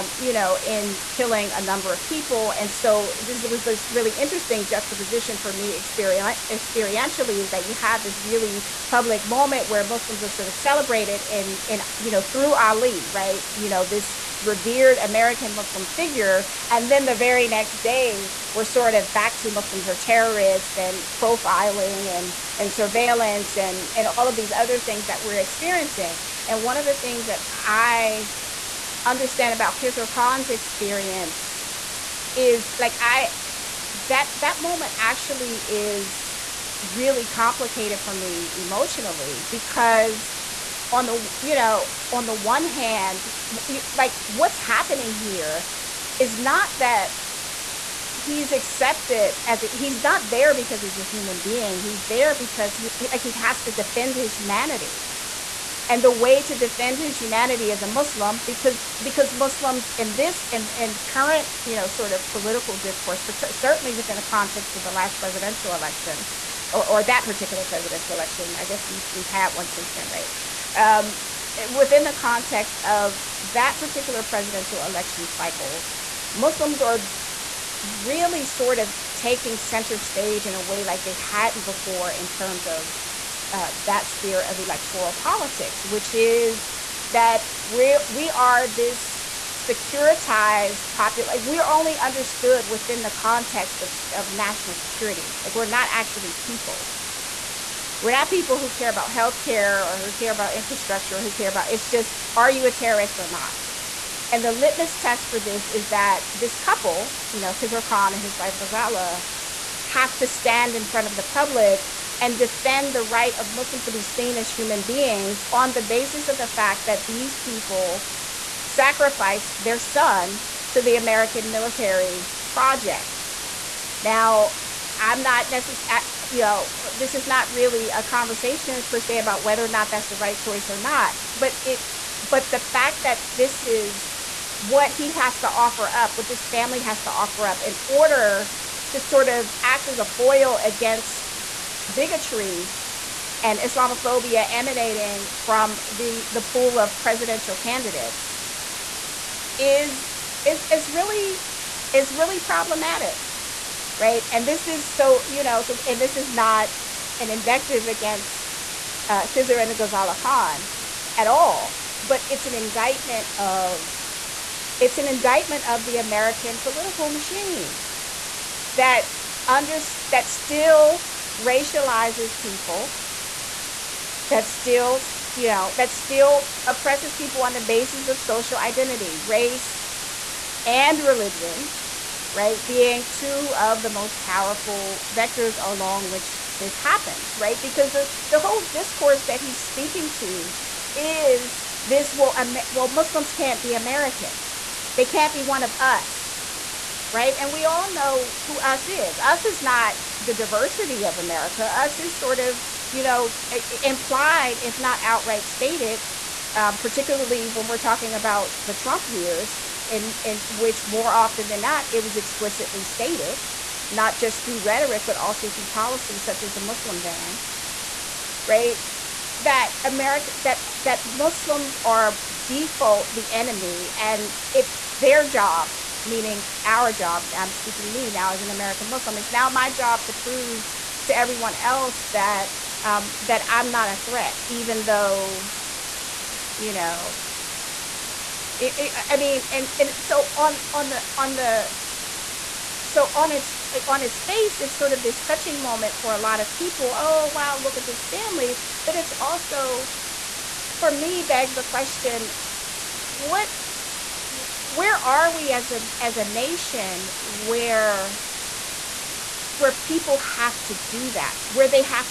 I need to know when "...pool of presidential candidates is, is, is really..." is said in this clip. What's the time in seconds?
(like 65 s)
146 s.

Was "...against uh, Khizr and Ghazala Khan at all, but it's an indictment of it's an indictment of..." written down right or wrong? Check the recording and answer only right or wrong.
right.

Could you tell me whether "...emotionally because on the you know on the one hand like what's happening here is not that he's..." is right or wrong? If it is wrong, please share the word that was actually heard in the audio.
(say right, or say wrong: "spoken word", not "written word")
right.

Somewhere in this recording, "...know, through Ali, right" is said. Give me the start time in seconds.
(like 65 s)
12 s.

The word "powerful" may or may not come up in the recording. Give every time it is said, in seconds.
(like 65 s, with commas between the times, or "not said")
184 s.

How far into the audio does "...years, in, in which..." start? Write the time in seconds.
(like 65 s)
209 s.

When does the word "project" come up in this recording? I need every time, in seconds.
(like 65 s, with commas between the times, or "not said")
122 s.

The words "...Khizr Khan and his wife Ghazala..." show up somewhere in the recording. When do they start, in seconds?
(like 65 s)
107 s.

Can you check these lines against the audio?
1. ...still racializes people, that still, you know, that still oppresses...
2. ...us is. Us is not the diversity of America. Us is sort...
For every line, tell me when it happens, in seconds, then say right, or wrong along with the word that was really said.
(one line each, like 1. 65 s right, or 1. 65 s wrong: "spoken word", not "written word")
1. 170 s right
2. 198 s right.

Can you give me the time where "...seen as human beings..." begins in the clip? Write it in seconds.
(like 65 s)
114 s.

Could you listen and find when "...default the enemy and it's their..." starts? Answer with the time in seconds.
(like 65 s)
222 s.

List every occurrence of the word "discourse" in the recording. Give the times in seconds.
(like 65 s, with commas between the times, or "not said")
62 s, 188 s.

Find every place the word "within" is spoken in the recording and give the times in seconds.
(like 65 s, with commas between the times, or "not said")
63 s, 71 s, 92 s.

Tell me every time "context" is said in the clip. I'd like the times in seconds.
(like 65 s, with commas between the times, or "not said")
64 s, 72 s, 93 s.